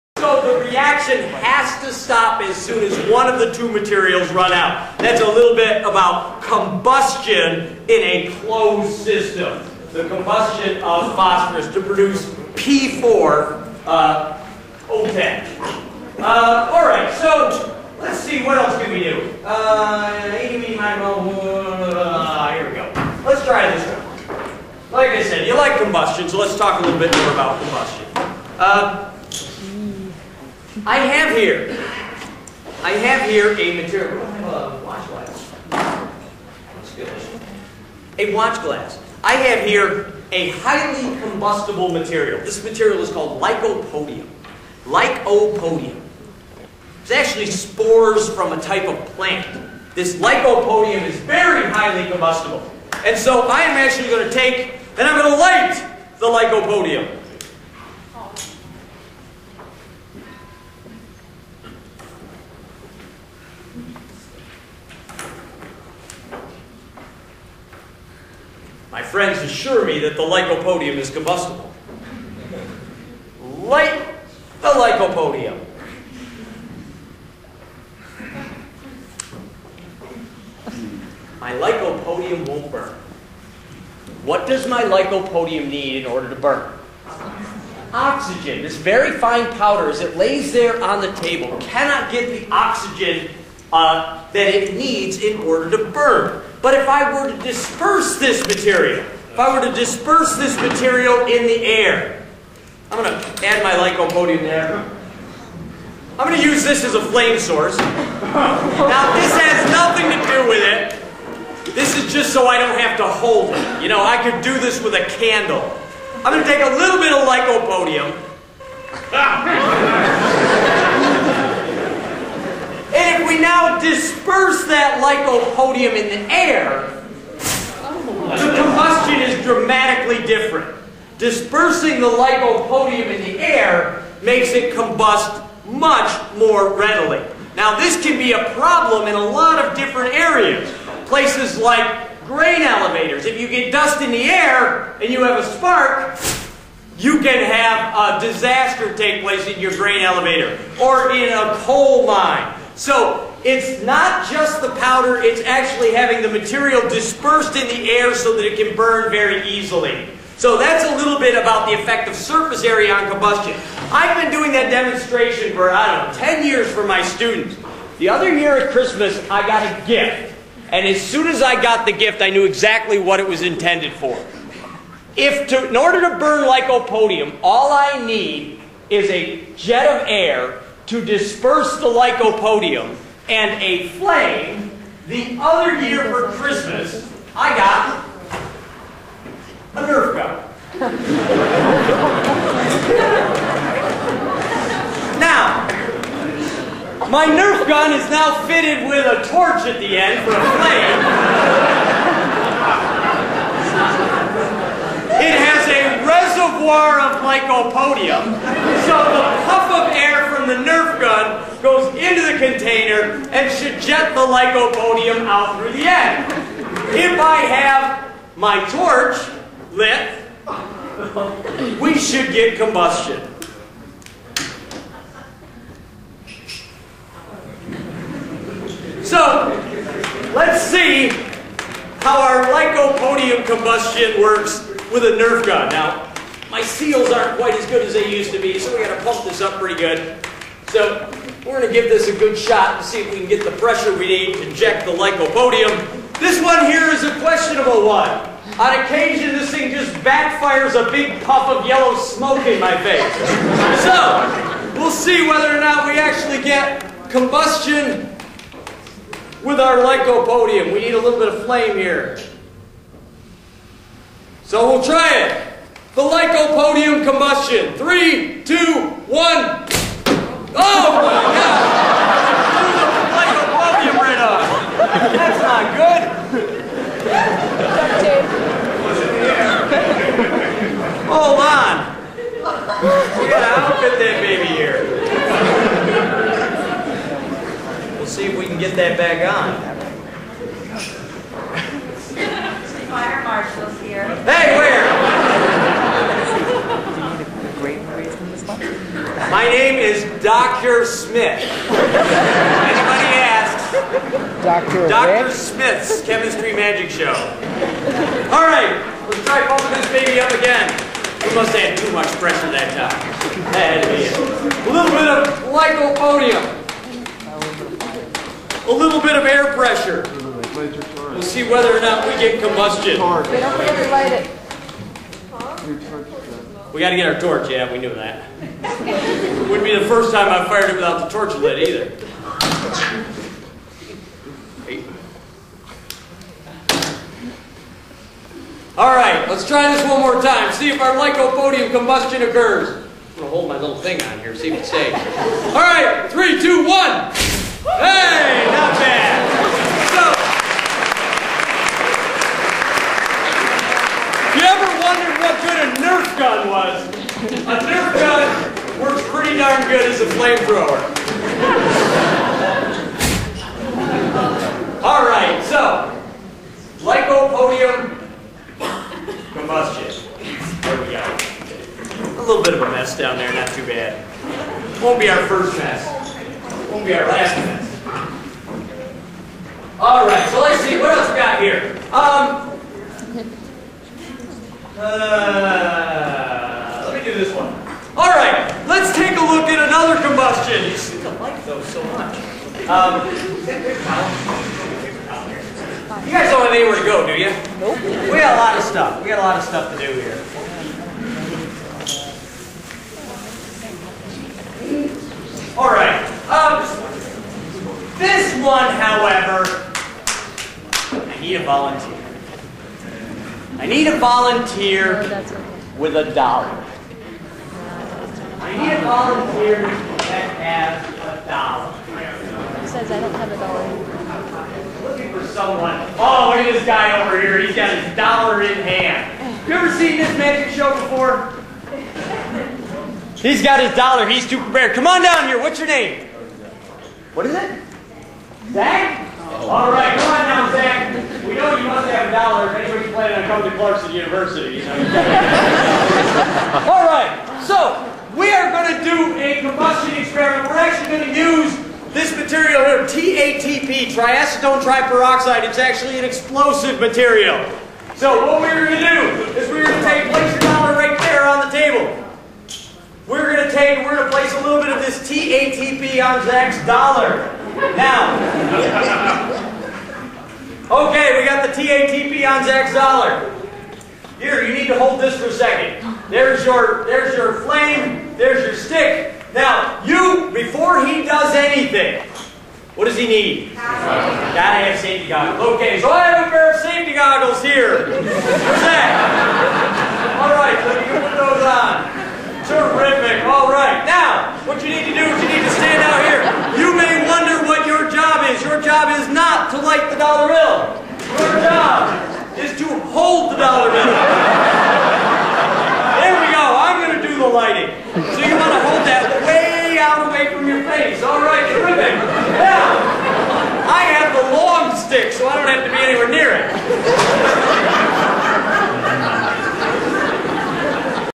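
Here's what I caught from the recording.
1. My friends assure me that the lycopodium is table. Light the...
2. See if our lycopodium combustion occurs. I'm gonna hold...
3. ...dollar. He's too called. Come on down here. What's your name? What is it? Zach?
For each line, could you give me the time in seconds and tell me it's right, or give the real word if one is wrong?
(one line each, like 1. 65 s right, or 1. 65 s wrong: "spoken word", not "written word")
1. 68 s wrong: "combustible", not "table"
2. 340 s right
3. 433 s wrong: "prepared", not "called".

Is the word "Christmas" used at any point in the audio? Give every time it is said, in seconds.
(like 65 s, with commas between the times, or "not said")
168 s, 186 s.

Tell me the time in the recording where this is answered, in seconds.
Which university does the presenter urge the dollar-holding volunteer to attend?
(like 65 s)
443 s.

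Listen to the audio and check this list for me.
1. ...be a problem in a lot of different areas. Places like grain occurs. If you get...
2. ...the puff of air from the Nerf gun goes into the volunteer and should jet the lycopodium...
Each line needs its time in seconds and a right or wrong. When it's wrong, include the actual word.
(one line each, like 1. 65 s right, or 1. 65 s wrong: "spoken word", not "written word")
1. 138 s wrong: "elevators", not "occurs"
2. 209 s wrong: "container", not "volunteer".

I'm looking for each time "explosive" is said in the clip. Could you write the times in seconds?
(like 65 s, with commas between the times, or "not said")
456 s.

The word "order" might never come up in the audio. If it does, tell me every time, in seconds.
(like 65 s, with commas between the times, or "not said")
86 s, 95 s, 175 s.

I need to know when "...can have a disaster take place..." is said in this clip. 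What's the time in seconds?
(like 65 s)
147 s.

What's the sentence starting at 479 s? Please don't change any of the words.
Now, you, before he does anything, what does he need?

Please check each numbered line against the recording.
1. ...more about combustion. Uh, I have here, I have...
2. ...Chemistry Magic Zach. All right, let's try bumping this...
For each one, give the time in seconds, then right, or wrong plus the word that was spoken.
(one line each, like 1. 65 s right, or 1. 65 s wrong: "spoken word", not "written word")
1. 27 s right
2. 306 s wrong: "Show", not "Zach".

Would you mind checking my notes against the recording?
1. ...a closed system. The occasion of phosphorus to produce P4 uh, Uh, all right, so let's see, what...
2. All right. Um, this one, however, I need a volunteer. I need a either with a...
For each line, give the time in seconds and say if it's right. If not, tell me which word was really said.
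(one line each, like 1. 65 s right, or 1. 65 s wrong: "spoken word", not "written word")
1. 7 s wrong: "combustion", not "occasion"
2. 405 s wrong: "volunteer", not "either".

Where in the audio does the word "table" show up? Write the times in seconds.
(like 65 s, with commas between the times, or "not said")
91 s, 461 s.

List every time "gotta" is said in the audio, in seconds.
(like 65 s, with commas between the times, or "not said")
283 s, 483 s.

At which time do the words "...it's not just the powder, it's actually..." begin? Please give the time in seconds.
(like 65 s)
153 s.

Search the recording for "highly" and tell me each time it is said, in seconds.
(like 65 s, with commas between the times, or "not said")
40 s, 51 s.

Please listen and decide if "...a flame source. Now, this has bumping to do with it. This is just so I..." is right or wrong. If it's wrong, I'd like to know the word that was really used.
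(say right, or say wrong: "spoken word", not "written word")
wrong: "nothing", not "bumping".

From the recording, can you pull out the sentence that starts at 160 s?
So that's a little bit about the effect of surface area on combustion.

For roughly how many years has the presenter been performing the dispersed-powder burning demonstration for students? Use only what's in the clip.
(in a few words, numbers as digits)
10 years.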